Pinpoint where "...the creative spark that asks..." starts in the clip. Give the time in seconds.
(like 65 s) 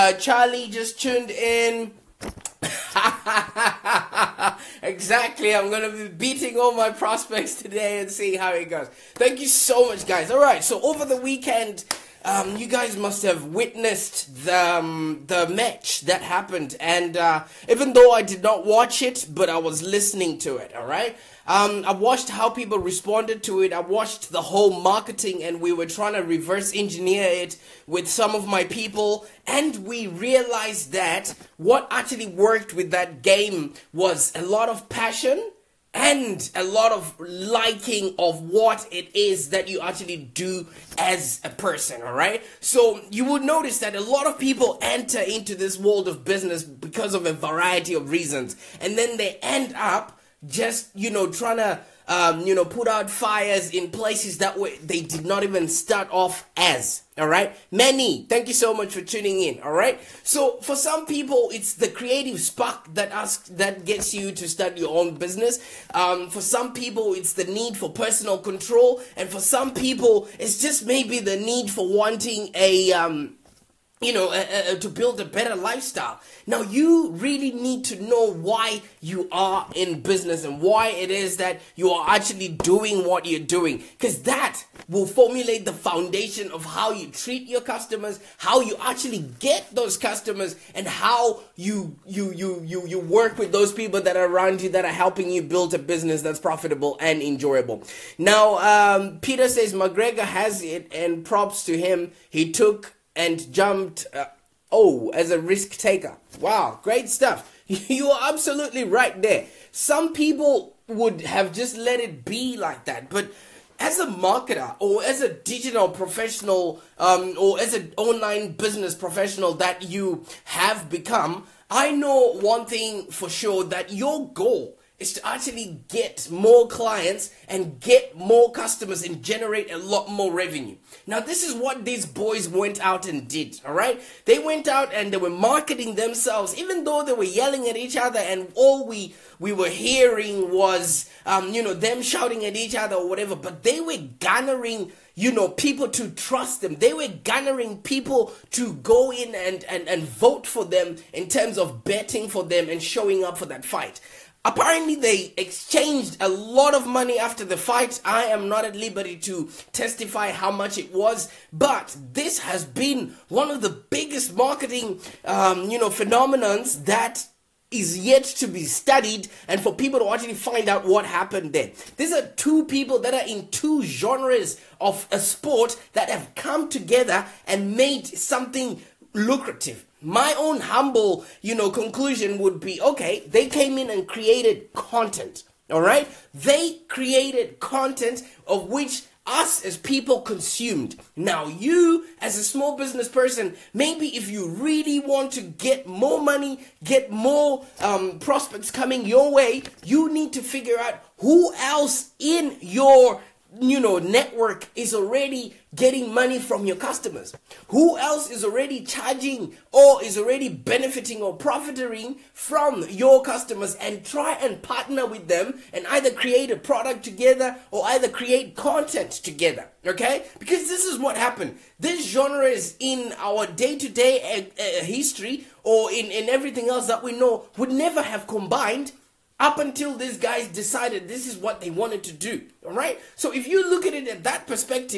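61 s.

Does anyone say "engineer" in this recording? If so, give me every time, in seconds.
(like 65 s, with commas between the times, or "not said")
26 s.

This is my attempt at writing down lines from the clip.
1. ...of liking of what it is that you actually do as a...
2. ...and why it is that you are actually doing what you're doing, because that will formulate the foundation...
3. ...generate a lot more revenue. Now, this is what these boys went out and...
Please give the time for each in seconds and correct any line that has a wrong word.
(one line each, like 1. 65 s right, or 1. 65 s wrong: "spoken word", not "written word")
1. 36 s right
2. 80 s right
3. 129 s right.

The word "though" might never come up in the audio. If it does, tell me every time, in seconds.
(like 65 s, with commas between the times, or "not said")
17 s, 136 s.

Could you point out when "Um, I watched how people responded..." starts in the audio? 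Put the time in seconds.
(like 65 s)
21 s.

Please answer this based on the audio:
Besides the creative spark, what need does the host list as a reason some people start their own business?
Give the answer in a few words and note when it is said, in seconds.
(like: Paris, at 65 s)
personal control, at 67 s.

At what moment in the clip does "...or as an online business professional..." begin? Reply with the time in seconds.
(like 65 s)
117 s.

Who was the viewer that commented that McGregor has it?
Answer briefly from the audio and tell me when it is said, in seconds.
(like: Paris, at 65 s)
Peter, at 99 s.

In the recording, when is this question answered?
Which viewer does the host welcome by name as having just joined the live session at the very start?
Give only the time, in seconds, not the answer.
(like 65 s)
0 s.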